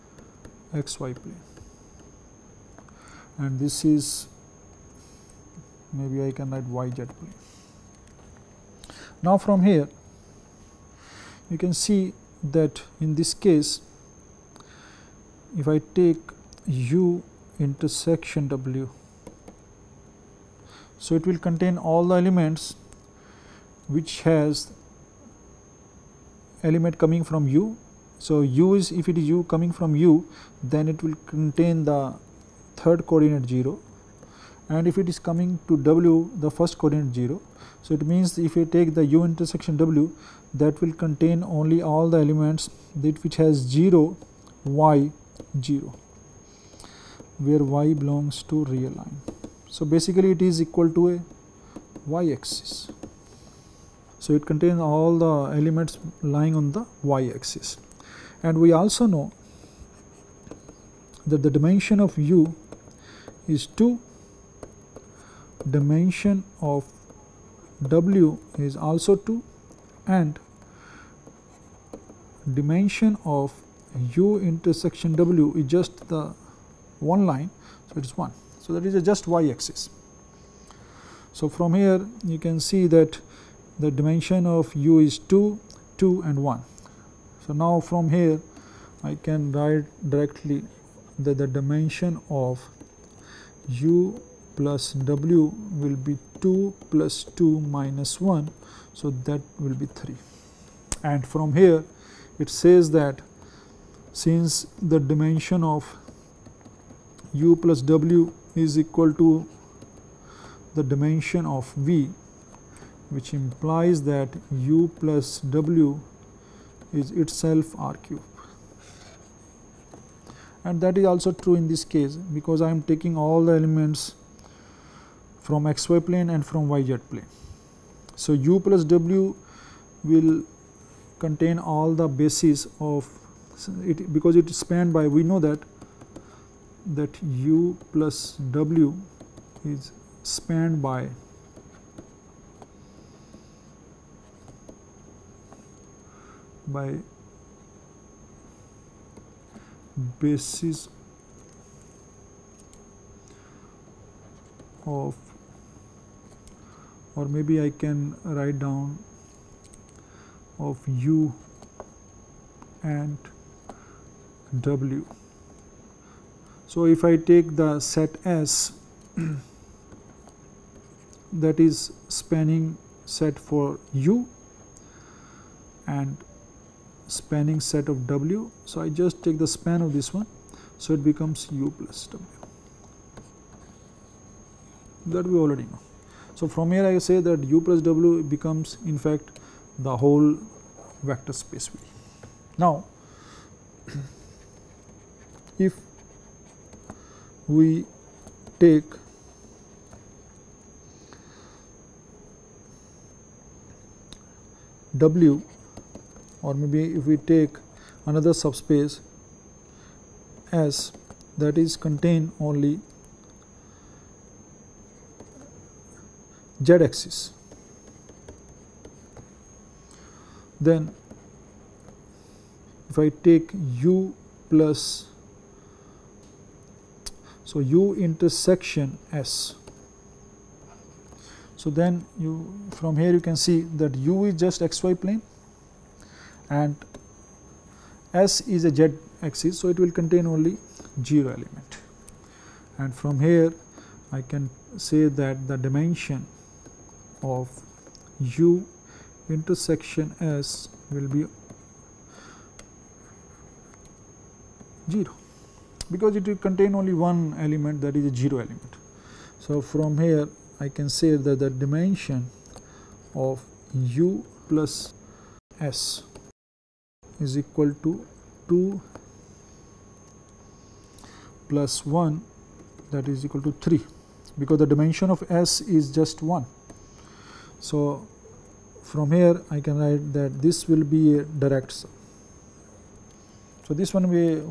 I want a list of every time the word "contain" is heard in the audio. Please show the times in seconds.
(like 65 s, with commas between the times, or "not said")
21 s, 31 s, 40 s, 54 s, 131 s, 211 s, 240 s, 256 s.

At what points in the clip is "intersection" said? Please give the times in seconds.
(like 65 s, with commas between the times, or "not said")
17 s, 39 s, 74 s, 228 s, 249 s.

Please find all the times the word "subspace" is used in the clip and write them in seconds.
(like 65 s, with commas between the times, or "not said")
208 s.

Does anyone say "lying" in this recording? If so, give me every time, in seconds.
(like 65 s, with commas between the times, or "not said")
56 s.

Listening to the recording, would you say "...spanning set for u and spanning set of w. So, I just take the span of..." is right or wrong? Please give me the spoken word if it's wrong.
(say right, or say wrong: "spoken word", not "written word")
right.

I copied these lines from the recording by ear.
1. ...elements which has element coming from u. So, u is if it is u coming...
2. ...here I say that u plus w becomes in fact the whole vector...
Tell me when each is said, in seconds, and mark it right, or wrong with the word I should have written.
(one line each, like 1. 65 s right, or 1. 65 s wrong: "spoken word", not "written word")
1. 22 s right
2. 186 s right.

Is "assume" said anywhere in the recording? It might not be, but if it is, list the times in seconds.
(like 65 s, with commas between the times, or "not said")
not said.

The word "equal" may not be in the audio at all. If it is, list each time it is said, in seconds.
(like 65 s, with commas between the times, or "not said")
50 s, 108 s, 267 s, 273 s.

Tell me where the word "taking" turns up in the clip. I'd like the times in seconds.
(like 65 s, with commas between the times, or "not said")
122 s.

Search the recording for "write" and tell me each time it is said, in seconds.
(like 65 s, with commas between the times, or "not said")
6 s, 89 s, 158 s, 279 s.